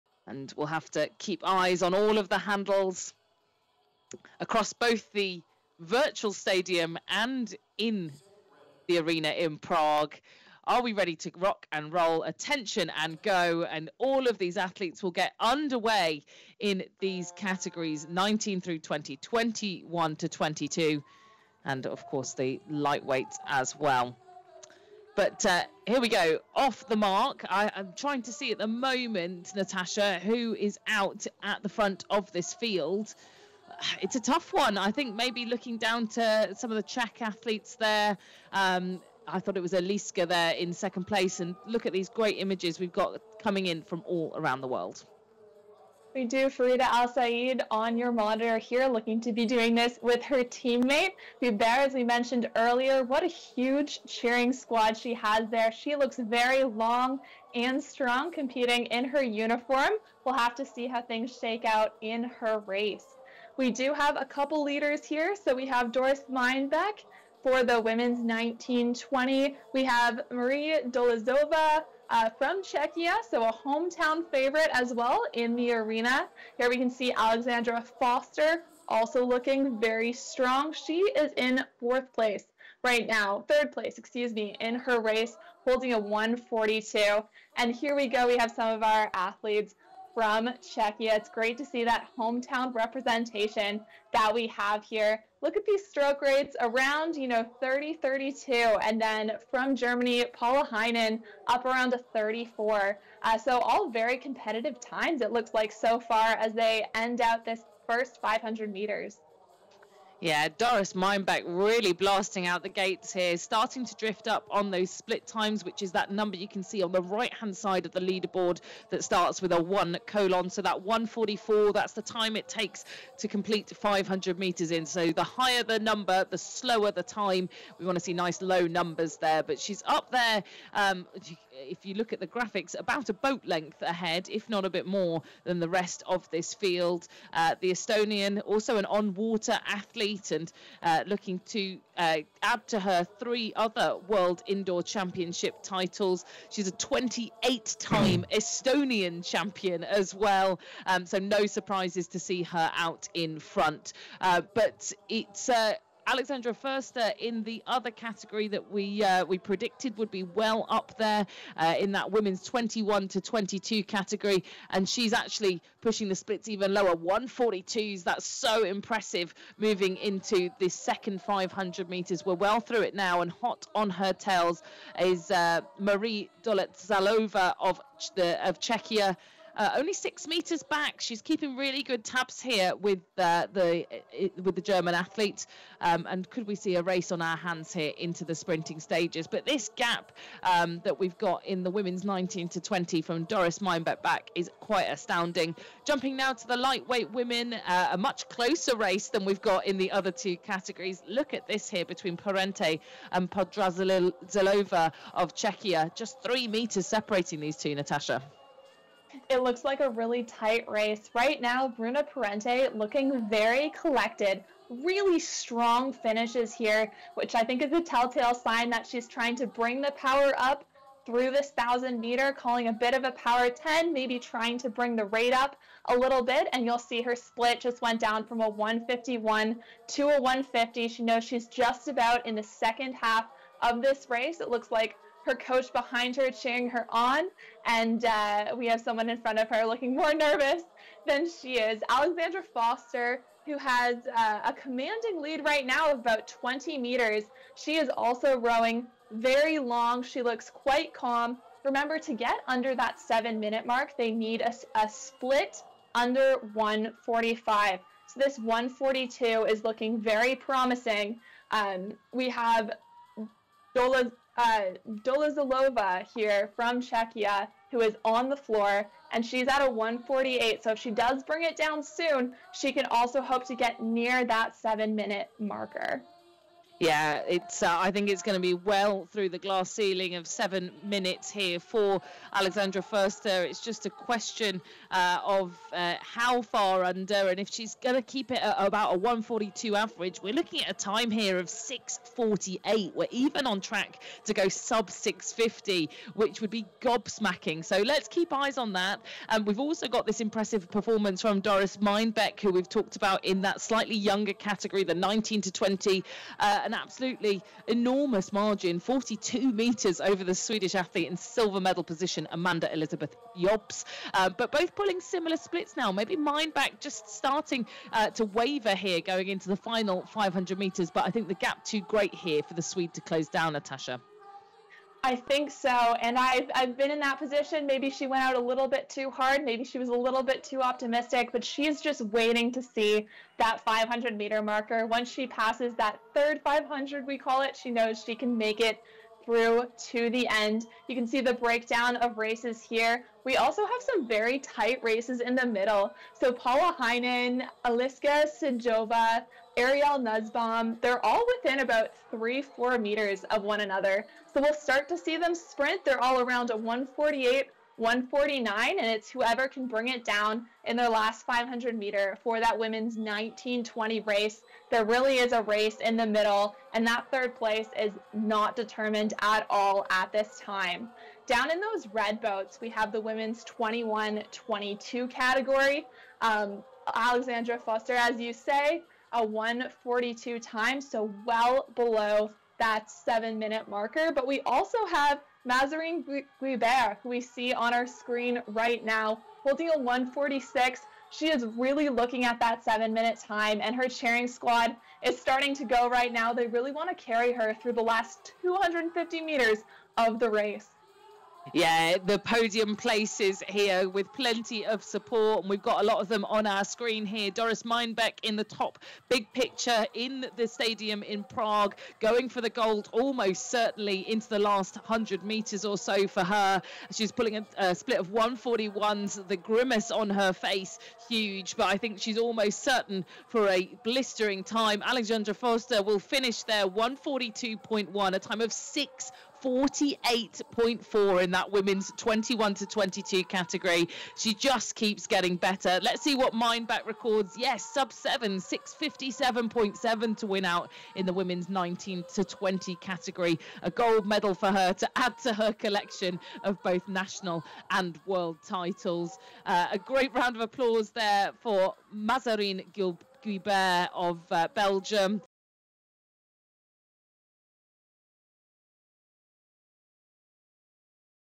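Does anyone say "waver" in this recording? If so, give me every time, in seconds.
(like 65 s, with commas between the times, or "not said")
318 s.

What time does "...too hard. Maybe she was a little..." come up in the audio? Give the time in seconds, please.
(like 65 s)
328 s.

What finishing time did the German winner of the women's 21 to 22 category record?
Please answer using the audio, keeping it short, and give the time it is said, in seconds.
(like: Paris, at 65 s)
6:48.4, at 429 s.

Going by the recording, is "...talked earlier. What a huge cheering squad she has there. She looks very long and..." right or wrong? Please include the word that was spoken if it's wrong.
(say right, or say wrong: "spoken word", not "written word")
wrong: "mentioned", not "talked".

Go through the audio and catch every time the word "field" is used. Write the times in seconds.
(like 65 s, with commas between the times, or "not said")
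32 s, 136 s.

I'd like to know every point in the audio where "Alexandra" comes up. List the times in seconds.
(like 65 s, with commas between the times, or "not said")
77 s, 156 s, 241 s, 282 s, 376 s, 424 s.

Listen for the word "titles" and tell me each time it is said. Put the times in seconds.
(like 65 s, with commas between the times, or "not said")
145 s, 448 s.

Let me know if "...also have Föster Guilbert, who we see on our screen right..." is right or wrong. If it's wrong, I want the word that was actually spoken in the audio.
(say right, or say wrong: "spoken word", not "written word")
wrong: "Mazarine", not "Föster".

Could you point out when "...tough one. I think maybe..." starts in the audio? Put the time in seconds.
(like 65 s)
34 s.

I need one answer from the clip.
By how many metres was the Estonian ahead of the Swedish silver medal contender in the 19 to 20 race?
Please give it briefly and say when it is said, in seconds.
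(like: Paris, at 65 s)
42, at 308 s.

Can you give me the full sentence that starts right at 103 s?
Uh, so all very competitive times, it looks like so far as they end out this first 500 meters.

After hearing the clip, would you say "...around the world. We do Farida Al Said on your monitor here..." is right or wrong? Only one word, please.
right.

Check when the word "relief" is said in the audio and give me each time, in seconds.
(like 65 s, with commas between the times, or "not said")
not said.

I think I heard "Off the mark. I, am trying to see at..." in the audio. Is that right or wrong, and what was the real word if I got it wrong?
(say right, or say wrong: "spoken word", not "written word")
right.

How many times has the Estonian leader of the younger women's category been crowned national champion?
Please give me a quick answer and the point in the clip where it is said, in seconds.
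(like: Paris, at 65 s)
28, at 146 s.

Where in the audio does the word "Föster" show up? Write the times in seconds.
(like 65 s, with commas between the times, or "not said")
78 s, 156 s, 242 s, 282 s, 377 s, 425 s.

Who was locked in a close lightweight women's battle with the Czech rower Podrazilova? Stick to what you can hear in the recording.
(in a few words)
Bruna Parente.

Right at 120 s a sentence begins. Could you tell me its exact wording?
So that 144, that's the time it takes to complete 500 meters in.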